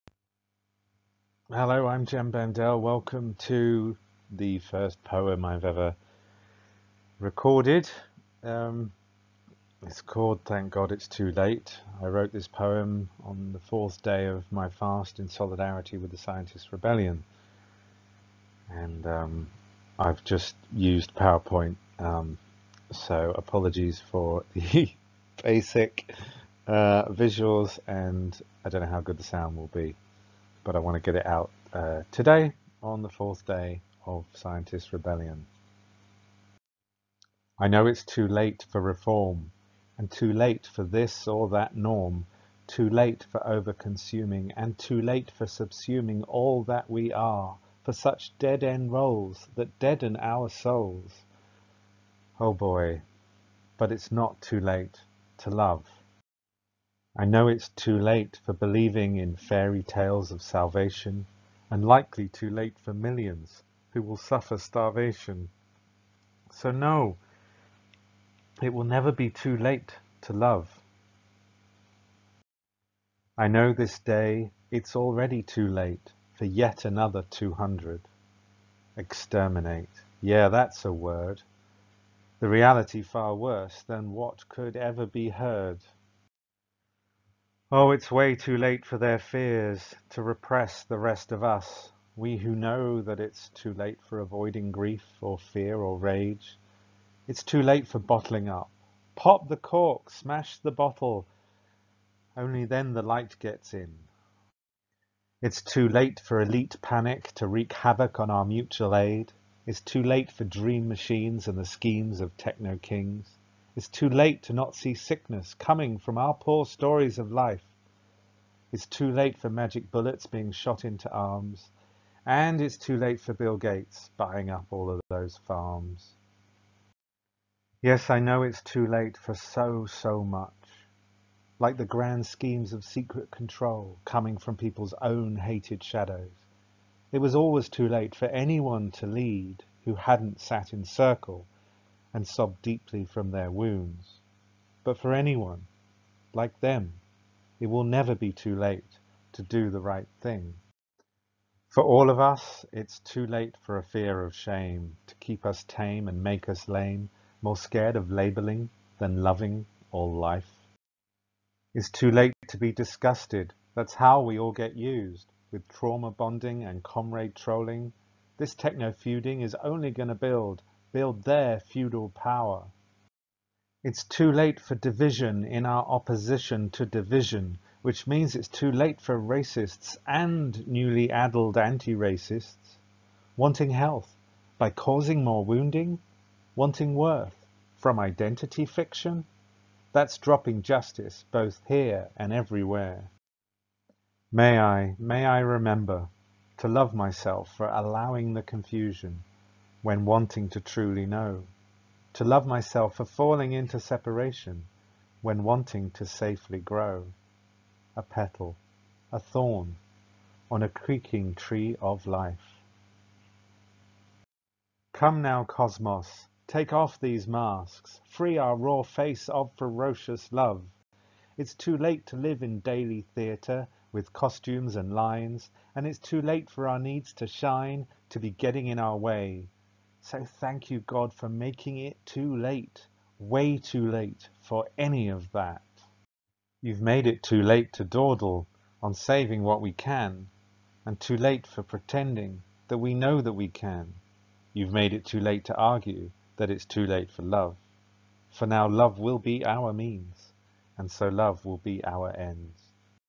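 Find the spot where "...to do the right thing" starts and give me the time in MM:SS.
02:29.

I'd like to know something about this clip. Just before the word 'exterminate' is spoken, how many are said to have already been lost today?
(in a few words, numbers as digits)
200.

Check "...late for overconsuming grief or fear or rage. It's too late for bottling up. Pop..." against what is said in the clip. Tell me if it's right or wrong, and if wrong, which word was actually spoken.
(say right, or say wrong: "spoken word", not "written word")
wrong: "avoiding", not "overconsuming".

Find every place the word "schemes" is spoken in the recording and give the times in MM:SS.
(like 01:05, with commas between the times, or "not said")
01:51, 02:12.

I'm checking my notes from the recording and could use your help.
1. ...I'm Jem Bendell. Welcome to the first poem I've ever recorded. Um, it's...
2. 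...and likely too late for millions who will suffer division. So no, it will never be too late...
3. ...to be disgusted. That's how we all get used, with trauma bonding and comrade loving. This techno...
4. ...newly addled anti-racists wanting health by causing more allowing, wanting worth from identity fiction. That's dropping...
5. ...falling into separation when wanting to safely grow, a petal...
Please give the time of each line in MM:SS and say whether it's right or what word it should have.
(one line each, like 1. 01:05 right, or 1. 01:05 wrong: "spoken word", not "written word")
1. 00:01 right
2. 01:01 wrong: "starvation", not "division"
3. 02:42 wrong: "trolling", not "loving"
4. 03:00 wrong: "wounding", not "allowing"
5. 03:23 right.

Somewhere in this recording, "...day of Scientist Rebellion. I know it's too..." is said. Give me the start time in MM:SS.
00:33.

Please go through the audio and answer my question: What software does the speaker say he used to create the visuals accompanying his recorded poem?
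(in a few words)
PowerPoint.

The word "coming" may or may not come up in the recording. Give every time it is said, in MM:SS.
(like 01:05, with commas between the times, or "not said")
01:55, 02:14.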